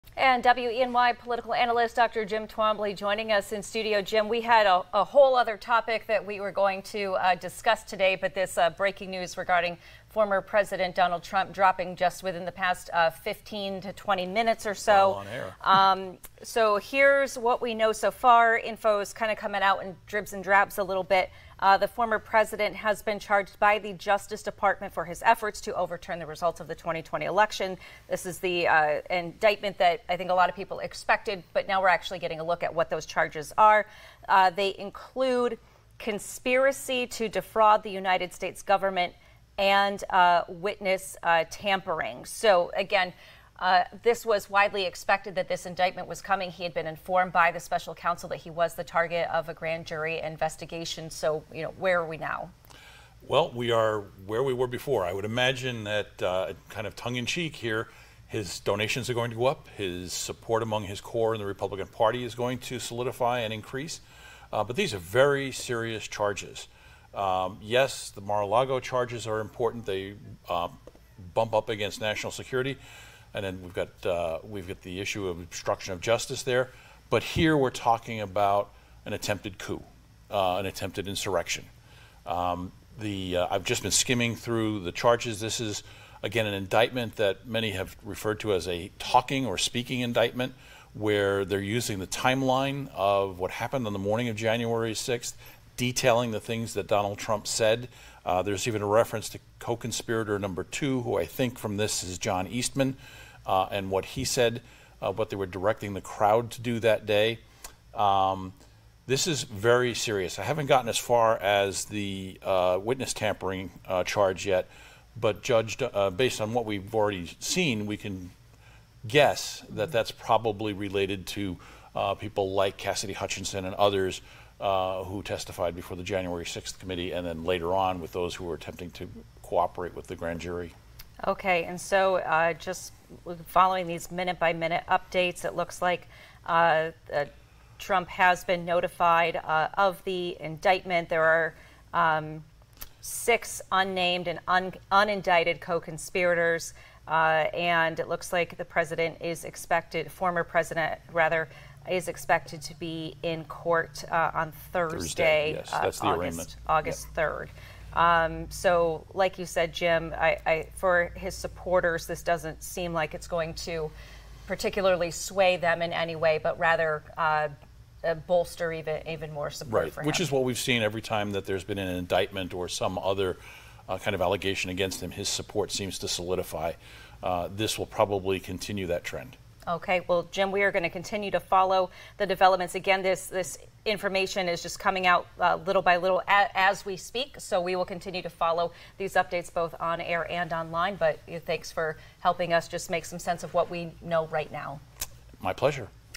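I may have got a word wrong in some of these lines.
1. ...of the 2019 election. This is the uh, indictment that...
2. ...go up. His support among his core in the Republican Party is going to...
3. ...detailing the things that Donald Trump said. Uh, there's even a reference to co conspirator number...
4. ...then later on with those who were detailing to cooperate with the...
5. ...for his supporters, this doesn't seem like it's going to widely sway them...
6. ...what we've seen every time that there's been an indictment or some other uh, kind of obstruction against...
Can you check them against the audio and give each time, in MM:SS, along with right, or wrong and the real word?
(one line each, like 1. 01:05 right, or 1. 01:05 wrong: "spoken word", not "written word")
1. 00:26 wrong: "2020", not "2019"
2. 00:59 right
3. 01:35 right
4. 02:07 wrong: "attempting", not "detailing"
5. 02:40 wrong: "particularly", not "widely"
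6. 02:50 wrong: "allegation", not "obstruction".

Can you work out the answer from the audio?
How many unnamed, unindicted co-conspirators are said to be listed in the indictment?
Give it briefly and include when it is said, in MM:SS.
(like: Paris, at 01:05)
6, at 02:23.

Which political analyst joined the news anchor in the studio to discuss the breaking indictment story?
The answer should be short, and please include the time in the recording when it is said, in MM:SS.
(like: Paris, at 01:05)
Dr. Jim Twombly, at 00:01.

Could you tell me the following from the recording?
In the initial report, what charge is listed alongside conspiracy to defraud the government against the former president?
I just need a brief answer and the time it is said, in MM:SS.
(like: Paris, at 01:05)
witness tampering, at 00:40.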